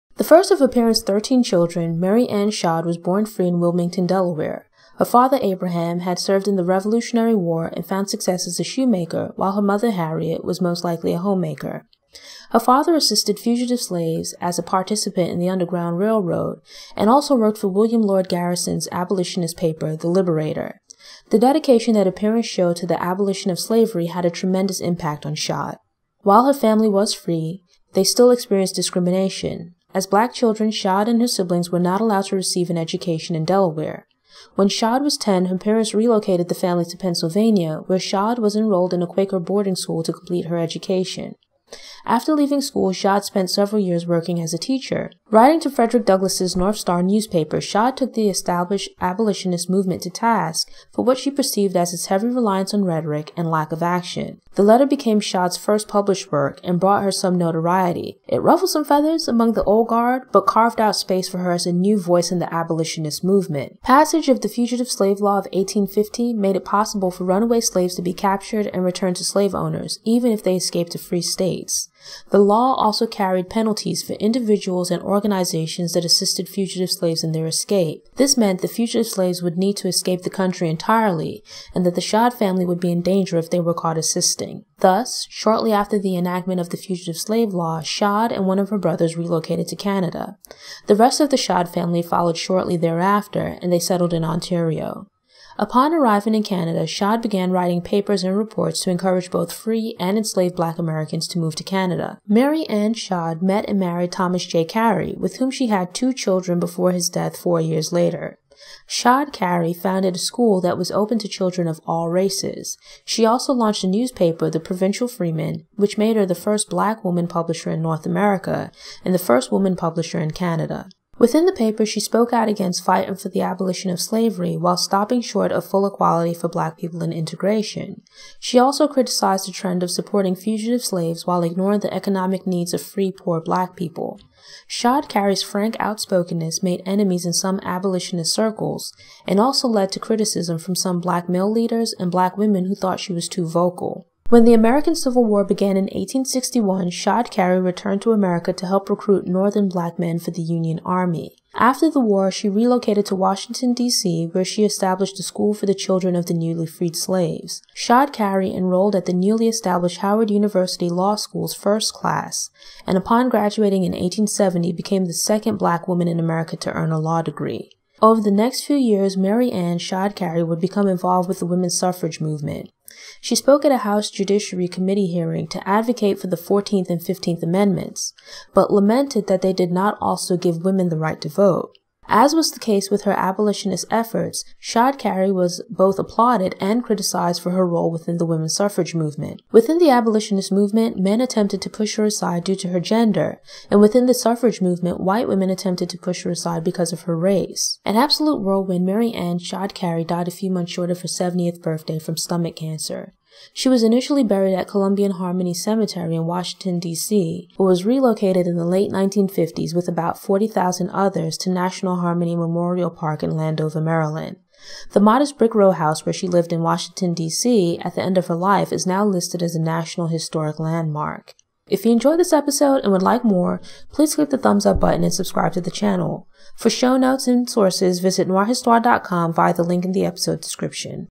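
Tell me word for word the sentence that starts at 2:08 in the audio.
She also criticized the trend of supporting fugitive slaves while ignoring the economic needs of free poor black people.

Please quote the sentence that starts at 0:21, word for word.
The dedication that her parents showed to the abolition of slavery had a tremendous impact on Shadd.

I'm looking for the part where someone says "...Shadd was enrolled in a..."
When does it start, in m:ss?
0:37.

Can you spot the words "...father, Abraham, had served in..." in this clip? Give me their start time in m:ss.
0:05.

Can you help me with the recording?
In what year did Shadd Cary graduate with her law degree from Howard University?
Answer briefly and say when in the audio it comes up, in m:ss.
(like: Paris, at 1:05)
1870, at 2:43.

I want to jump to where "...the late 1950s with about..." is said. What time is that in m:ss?
3:28.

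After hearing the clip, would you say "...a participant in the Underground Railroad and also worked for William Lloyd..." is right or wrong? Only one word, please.
right.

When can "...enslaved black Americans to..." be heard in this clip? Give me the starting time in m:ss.
1:40.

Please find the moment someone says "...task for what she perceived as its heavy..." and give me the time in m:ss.
0:50.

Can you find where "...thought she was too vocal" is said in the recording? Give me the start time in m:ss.
2:22.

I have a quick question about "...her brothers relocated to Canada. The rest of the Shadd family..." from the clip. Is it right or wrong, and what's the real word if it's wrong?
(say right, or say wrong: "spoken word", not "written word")
right.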